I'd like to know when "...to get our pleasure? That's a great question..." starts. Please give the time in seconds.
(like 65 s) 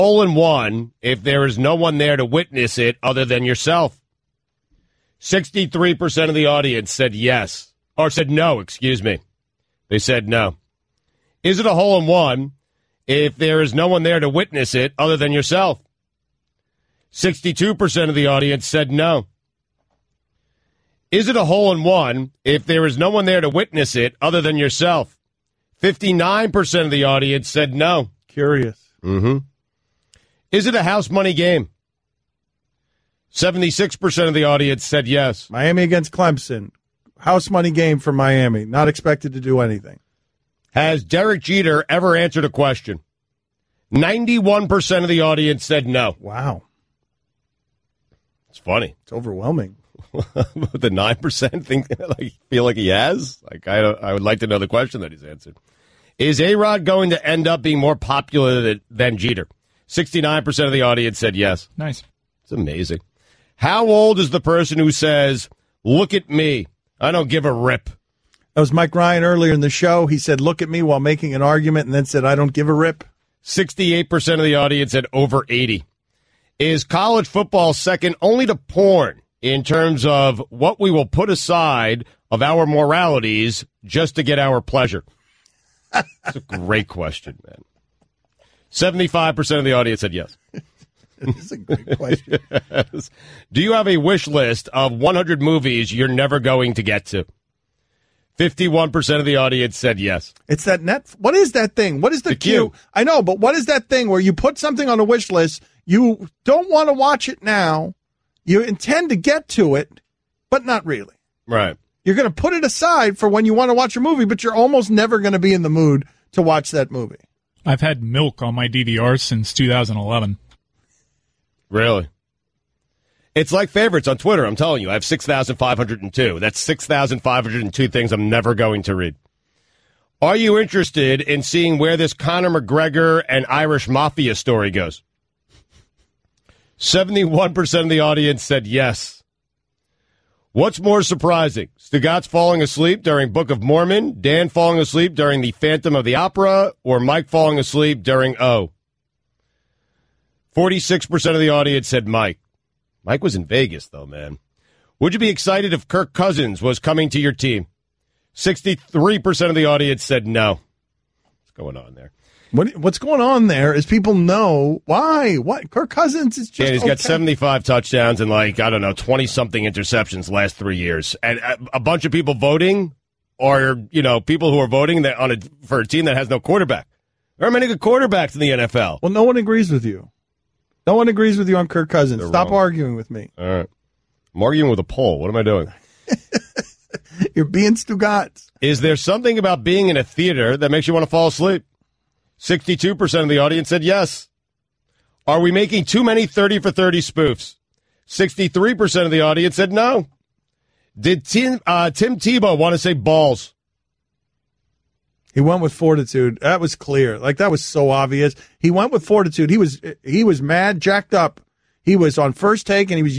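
84 s.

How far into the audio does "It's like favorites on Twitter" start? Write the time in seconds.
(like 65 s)
123 s.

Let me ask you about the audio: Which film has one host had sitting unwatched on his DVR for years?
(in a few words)
Milk.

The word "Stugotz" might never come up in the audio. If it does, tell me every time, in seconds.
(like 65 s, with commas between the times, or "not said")
141 s, 187 s.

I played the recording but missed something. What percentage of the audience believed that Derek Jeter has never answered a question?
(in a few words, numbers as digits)
91%.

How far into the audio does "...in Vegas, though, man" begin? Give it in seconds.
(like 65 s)
153 s.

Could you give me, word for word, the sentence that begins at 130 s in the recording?
Are you interested in seeing where this Conor McGregor and Irish Mafia story goes?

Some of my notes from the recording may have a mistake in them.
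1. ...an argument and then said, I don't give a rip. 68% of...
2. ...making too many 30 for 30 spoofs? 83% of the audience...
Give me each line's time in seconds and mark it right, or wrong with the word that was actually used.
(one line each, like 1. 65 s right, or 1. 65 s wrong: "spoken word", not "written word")
1. 71 s right
2. 195 s wrong: "63", not "83".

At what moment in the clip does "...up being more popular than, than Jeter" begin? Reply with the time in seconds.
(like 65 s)
57 s.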